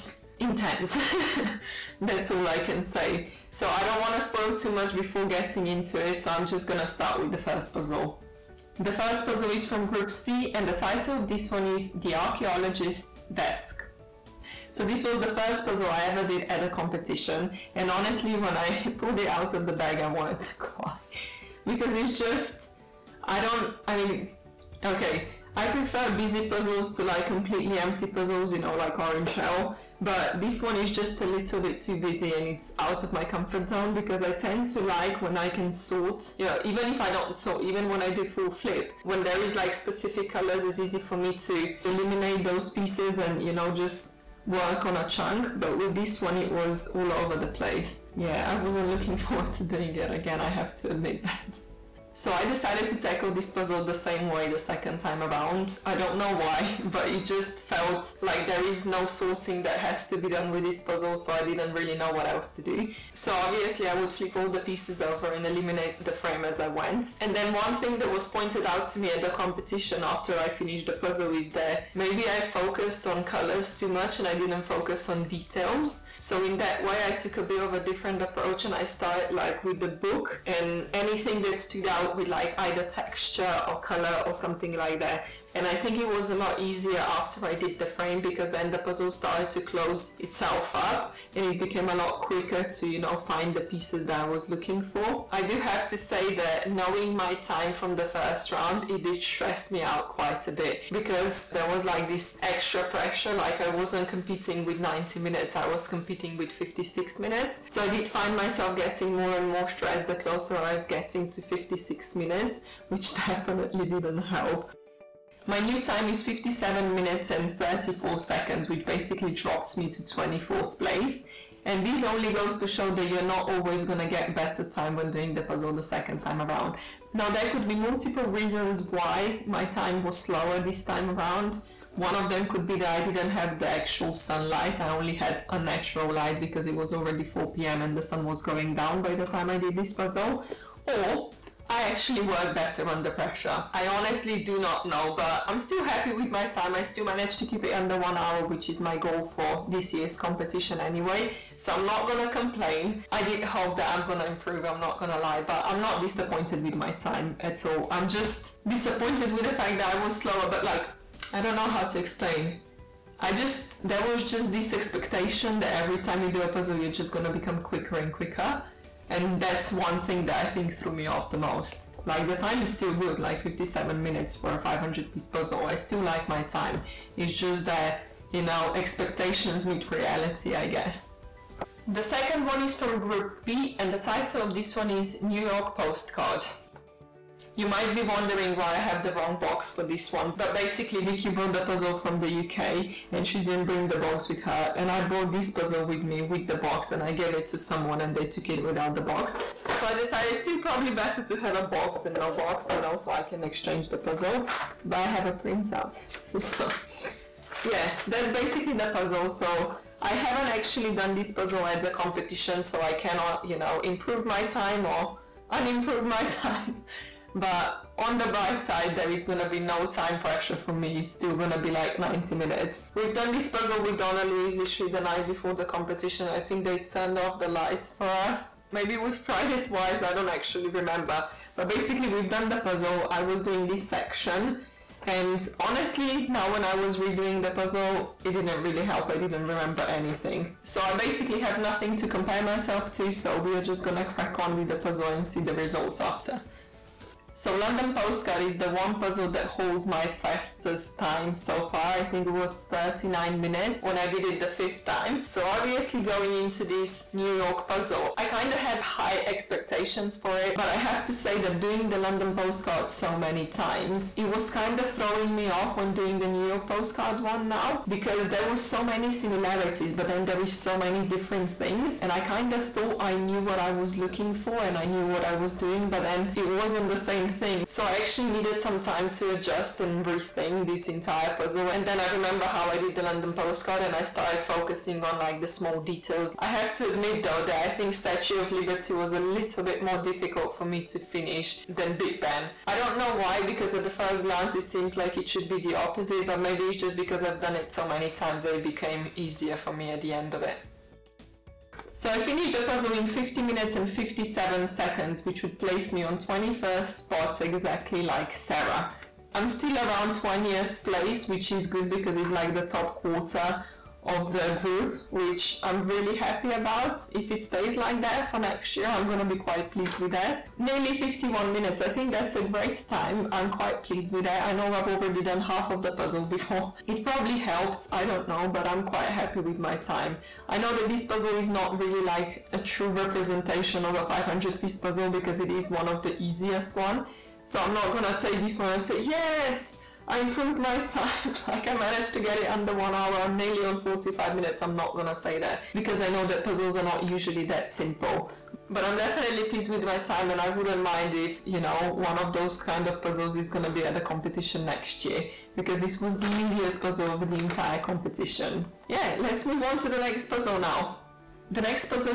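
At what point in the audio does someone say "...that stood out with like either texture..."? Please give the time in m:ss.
1:21.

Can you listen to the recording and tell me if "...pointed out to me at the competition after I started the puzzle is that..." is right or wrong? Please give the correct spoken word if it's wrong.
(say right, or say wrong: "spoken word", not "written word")
wrong: "finished", not "started".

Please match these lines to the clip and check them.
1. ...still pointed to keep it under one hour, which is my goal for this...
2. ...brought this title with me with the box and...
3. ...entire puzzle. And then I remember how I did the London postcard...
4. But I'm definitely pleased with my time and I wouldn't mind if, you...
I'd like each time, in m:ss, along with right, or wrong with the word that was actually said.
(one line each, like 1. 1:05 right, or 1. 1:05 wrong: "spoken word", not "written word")
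1. 2:26 wrong: "managed", not "pointed"
2. 3:15 wrong: "puzzle", not "title"
3. 4:40 right
4. 5:48 right.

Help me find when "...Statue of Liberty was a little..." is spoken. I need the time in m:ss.
4:47.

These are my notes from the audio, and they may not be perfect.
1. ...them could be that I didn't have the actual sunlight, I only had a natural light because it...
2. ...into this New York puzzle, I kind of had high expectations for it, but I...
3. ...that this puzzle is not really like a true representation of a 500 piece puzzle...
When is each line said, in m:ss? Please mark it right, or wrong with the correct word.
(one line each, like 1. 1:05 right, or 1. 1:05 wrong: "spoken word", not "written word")
1. 2:12 right
2. 4:16 right
3. 5:30 right.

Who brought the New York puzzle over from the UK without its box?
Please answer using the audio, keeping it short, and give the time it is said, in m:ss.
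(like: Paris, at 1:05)
Vicky, at 3:11.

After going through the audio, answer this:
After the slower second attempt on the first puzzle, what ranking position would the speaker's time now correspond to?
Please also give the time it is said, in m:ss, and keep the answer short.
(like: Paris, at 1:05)
24th place, at 2:00.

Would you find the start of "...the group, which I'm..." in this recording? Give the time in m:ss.
5:14.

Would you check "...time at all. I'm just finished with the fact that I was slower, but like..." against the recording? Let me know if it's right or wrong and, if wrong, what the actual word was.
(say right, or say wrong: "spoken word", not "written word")
wrong: "disappointed", not "finished".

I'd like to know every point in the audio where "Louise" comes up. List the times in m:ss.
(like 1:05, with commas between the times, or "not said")
3:44.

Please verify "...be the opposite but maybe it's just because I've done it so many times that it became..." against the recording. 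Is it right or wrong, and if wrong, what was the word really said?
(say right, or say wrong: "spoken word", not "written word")
right.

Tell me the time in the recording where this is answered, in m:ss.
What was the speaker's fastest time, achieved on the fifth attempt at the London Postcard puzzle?
4:12.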